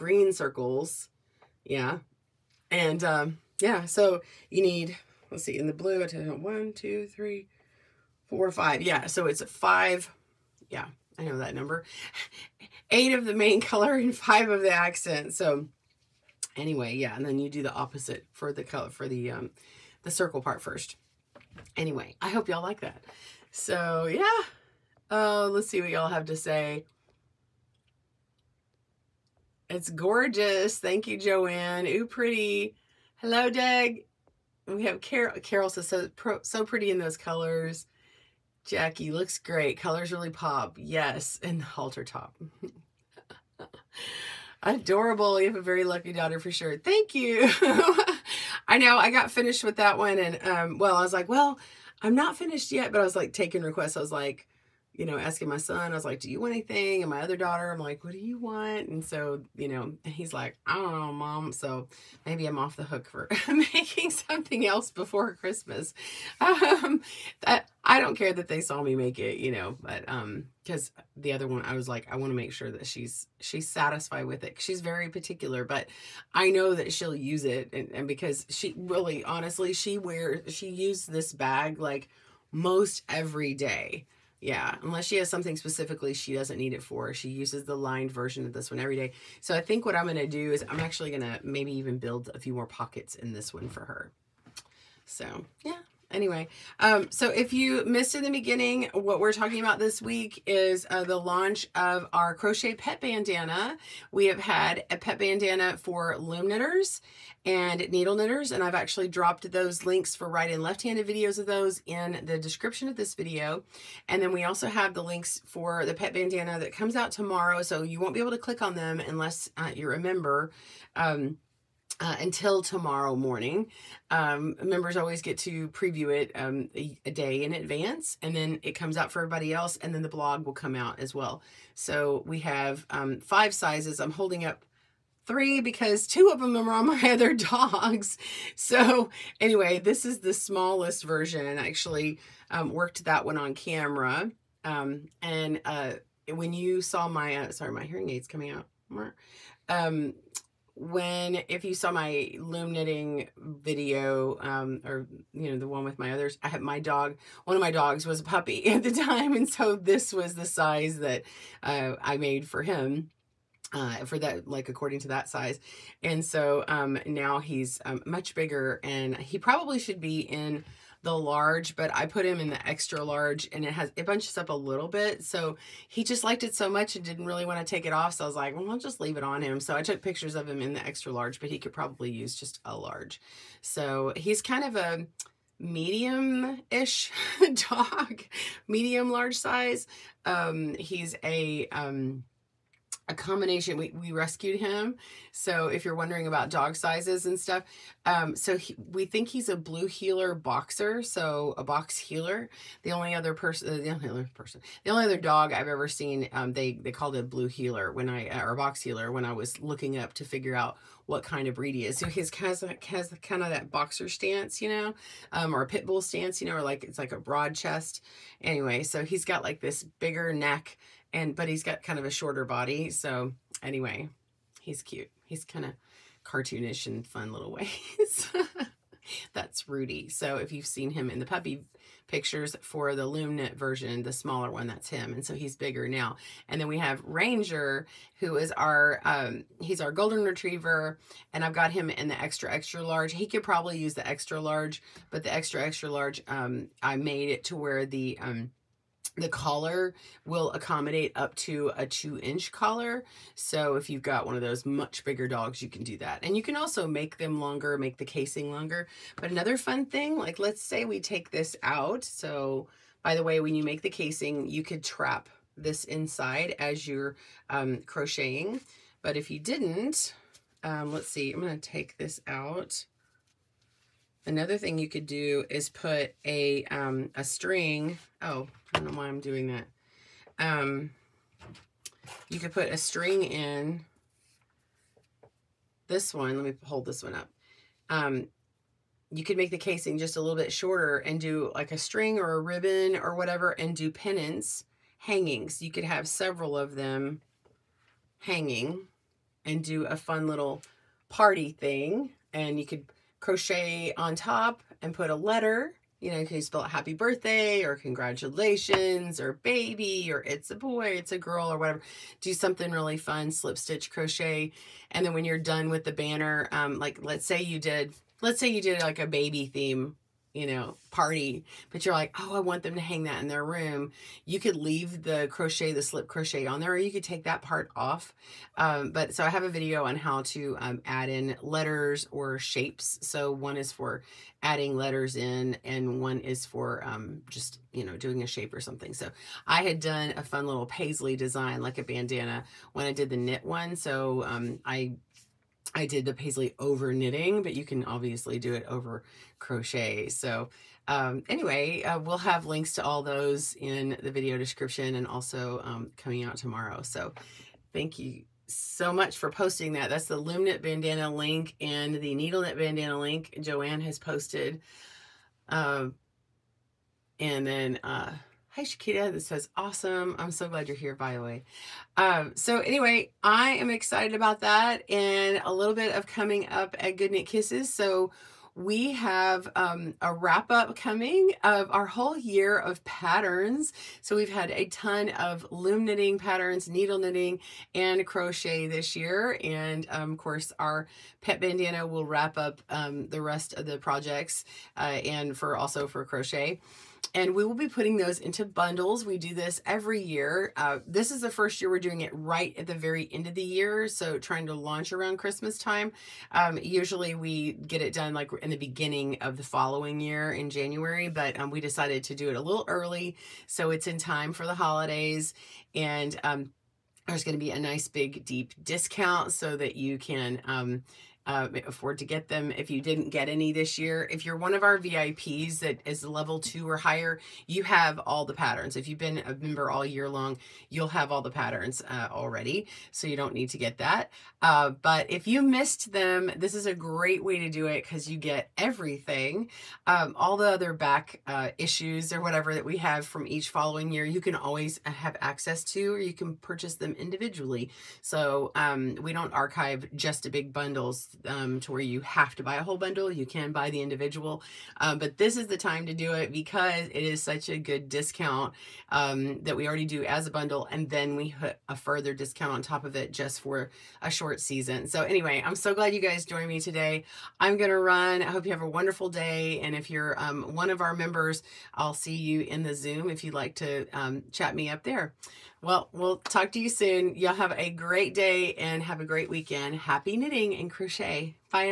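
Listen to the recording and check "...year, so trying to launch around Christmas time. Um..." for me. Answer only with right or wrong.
right.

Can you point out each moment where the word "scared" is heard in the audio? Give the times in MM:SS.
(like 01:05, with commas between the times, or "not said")
not said.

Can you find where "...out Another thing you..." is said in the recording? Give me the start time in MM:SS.
04:32.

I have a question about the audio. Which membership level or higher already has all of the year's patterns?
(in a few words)
Level 2.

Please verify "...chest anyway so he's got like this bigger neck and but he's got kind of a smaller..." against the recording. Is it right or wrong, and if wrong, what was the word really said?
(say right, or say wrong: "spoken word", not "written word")
wrong: "shorter", not "smaller".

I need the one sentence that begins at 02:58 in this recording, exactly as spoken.
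So I was like, well, I'll just leave it on him.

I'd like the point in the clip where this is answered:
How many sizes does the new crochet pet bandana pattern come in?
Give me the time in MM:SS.
02:13.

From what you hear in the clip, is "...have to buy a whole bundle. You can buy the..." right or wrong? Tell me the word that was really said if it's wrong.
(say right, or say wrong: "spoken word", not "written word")
right.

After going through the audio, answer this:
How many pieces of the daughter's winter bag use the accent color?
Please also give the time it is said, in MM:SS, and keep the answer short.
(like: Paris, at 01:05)
5, at 00:14.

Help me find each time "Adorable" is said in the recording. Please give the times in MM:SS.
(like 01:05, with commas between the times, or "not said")
00:44.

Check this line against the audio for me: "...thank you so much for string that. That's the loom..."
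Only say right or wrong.
wrong.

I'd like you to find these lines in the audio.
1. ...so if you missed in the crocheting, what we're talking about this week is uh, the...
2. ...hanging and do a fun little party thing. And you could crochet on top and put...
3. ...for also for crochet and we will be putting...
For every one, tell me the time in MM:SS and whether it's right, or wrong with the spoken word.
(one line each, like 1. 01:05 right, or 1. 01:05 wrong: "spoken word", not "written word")
1. 01:37 wrong: "beginning", not "crocheting"
2. 04:58 right
3. 06:35 right.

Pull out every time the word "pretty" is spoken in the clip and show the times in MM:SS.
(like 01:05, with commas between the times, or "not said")
00:32, 00:36.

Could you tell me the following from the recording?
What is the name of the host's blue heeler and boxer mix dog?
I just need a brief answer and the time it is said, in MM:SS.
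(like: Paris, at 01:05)
Rudy, at 03:49.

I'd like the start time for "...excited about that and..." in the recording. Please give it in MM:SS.
06:13.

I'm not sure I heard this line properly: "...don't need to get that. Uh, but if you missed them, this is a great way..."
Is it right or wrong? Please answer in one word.
right.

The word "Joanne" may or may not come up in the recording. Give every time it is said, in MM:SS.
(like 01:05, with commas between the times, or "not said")
00:31, 06:03.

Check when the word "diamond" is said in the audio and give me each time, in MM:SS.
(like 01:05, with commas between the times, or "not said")
not said.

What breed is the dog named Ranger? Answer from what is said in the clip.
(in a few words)
Golden retriever.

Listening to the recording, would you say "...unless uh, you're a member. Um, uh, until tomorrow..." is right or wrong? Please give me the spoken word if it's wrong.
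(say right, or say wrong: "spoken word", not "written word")
right.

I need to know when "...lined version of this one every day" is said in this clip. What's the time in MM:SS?
01:27.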